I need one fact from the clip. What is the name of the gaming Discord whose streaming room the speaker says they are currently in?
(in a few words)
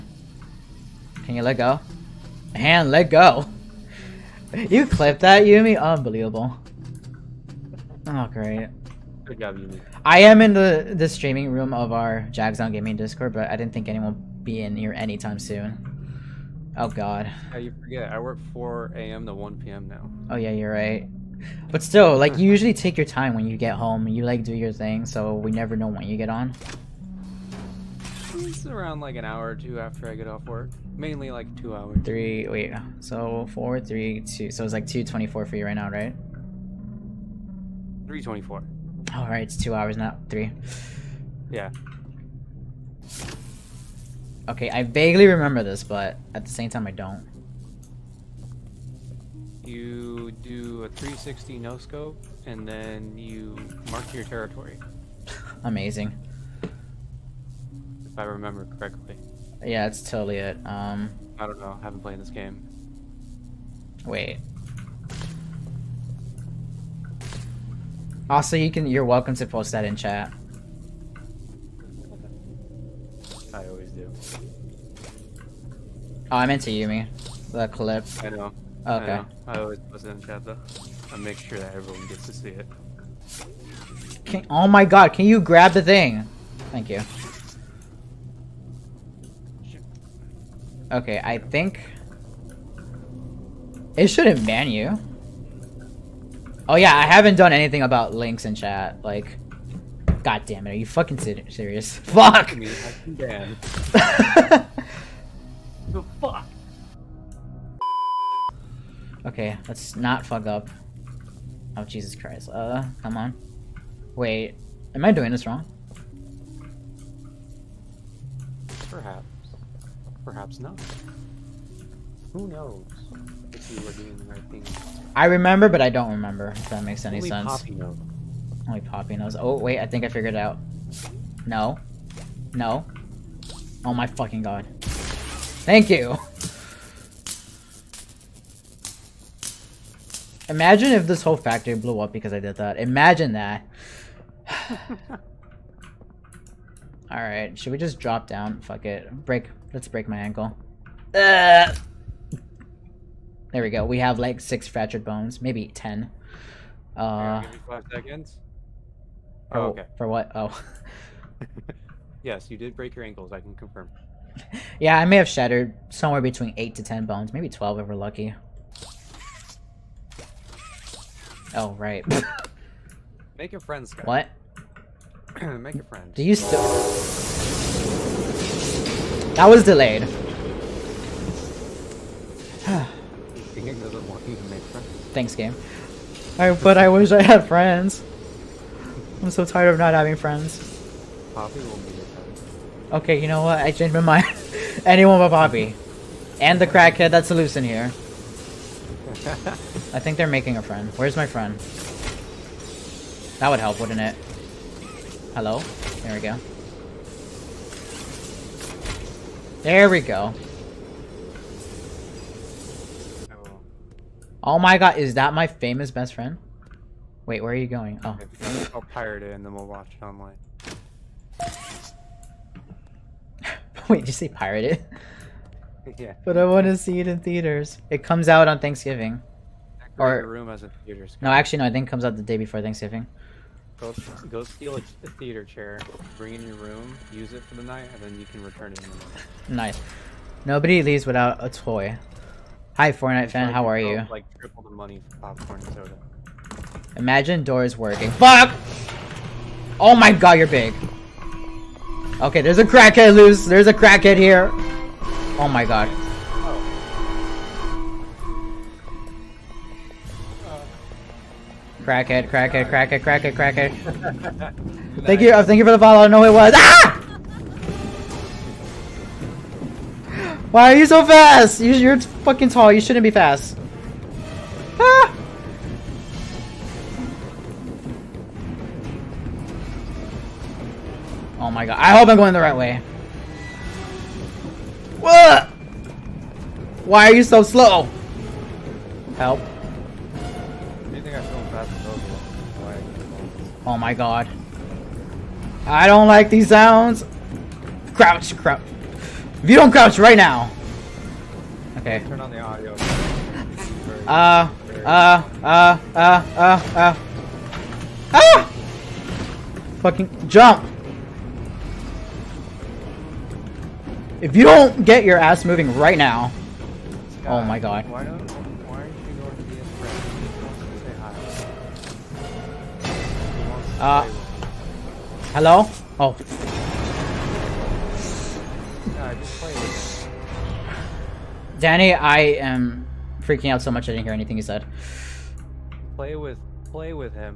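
Jagdzaun Gaming.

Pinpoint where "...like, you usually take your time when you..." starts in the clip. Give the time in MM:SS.
00:22.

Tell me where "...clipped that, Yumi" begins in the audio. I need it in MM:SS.
00:04.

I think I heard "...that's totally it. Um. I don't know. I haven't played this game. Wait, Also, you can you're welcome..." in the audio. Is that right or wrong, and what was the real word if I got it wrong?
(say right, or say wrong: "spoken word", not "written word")
right.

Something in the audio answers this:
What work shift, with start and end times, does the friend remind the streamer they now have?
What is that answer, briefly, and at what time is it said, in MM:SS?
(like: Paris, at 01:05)
4 a.m. to 1 p.m., at 00:18.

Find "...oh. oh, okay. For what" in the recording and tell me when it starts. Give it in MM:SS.
02:39.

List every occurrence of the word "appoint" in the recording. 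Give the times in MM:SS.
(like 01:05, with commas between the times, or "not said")
not said.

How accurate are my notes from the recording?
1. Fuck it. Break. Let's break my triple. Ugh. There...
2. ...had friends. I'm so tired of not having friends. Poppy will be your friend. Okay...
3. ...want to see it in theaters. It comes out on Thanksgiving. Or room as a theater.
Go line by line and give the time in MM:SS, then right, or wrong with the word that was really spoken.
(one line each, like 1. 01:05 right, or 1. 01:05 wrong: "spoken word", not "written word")
1. 02:28 wrong: "ankle", not "triple"
2. 03:07 right
3. 03:46 right.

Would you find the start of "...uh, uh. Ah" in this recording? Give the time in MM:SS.
05:06.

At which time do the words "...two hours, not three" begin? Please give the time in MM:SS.
00:39.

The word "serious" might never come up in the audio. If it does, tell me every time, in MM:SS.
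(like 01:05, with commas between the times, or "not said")
01:41.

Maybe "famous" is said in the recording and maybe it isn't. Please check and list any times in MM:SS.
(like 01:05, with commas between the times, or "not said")
03:35.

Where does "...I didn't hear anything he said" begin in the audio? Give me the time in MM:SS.
05:33.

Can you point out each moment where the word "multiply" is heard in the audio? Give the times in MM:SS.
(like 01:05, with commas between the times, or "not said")
not said.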